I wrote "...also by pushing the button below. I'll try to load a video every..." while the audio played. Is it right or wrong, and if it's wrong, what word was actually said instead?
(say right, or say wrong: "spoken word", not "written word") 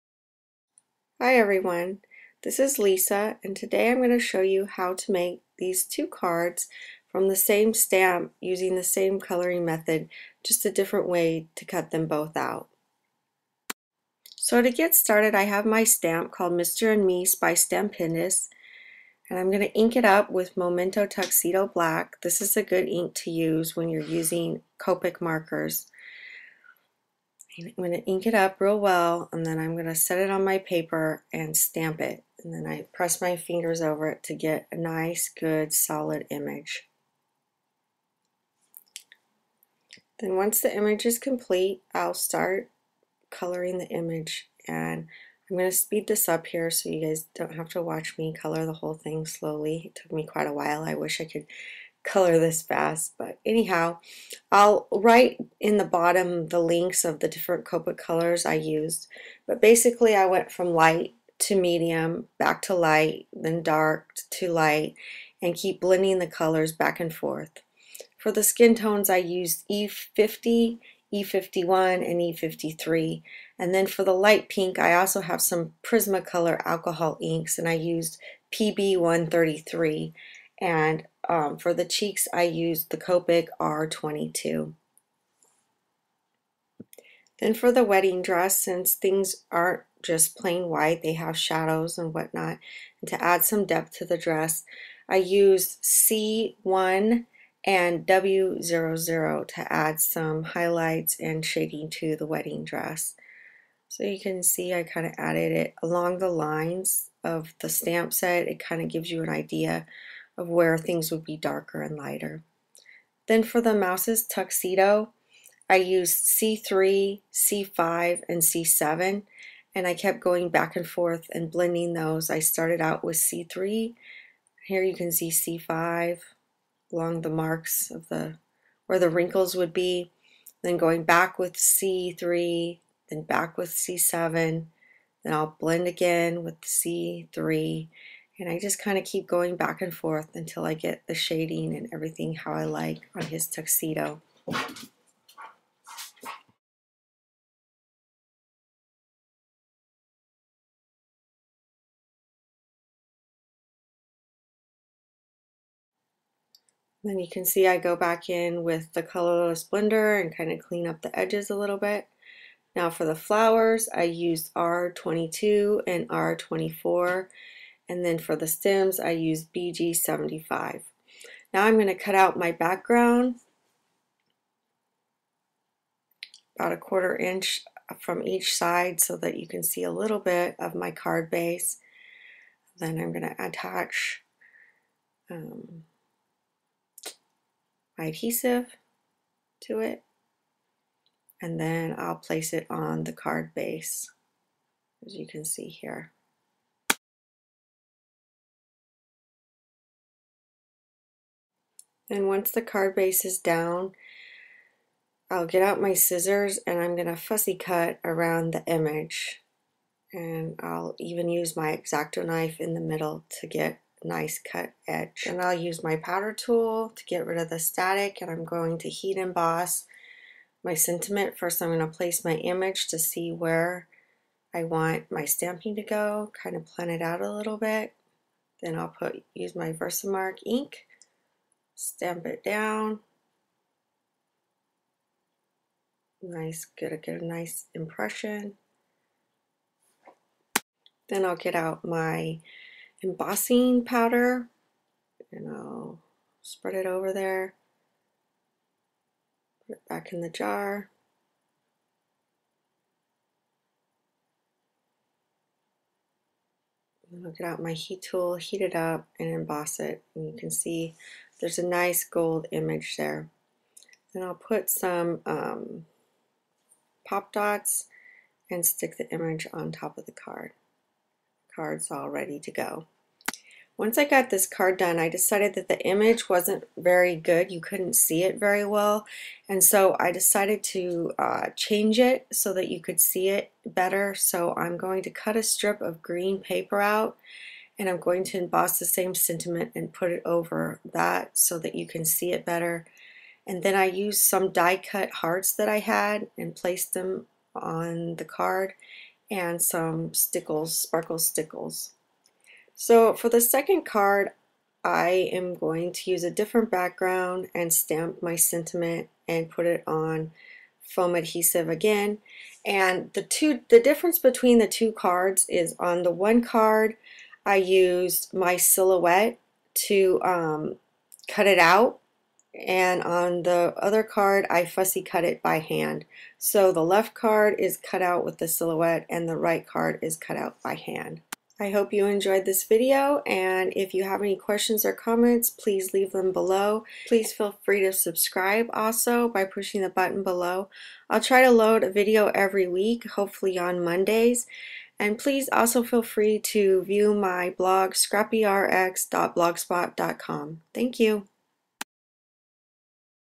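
right.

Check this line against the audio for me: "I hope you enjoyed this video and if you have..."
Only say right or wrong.
right.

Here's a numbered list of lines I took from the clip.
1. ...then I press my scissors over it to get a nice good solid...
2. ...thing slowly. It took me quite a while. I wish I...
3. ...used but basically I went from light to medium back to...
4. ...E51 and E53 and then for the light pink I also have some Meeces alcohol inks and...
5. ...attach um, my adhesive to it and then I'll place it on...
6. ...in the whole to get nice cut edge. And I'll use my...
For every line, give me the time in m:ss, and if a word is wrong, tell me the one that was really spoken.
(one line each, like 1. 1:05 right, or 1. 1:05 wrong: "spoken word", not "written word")
1. 0:32 wrong: "fingers", not "scissors"
2. 0:48 right
3. 0:58 right
4. 1:11 wrong: "Prismacolor", not "Meeces"
5. 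3:03 right
6. 3:32 wrong: "middle", not "whole".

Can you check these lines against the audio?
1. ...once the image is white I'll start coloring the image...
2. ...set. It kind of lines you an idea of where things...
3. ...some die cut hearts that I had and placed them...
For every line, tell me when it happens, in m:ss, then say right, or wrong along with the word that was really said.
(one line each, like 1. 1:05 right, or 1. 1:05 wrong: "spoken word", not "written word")
1. 0:40 wrong: "complete", not "white"
2. 1:48 wrong: "gives", not "lines"
3. 4:54 right.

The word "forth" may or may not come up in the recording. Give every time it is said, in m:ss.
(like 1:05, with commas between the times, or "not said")
1:07, 2:00, 2:19.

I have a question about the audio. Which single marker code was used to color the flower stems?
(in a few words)
BG75.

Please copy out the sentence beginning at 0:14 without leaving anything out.
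So to get started I have my stamp called Mr.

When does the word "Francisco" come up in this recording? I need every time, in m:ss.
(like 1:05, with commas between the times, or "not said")
not said.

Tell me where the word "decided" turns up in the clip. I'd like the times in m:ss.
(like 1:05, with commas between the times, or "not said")
4:35, 4:40.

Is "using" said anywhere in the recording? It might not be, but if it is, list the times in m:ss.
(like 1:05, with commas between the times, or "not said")
0:08, 0:24.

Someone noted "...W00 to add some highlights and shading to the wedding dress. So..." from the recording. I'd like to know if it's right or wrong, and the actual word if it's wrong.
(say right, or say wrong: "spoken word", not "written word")
right.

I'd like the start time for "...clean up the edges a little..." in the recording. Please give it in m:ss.
2:40.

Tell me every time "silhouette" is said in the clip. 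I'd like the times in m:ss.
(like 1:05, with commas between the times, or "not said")
5:18, 5:28.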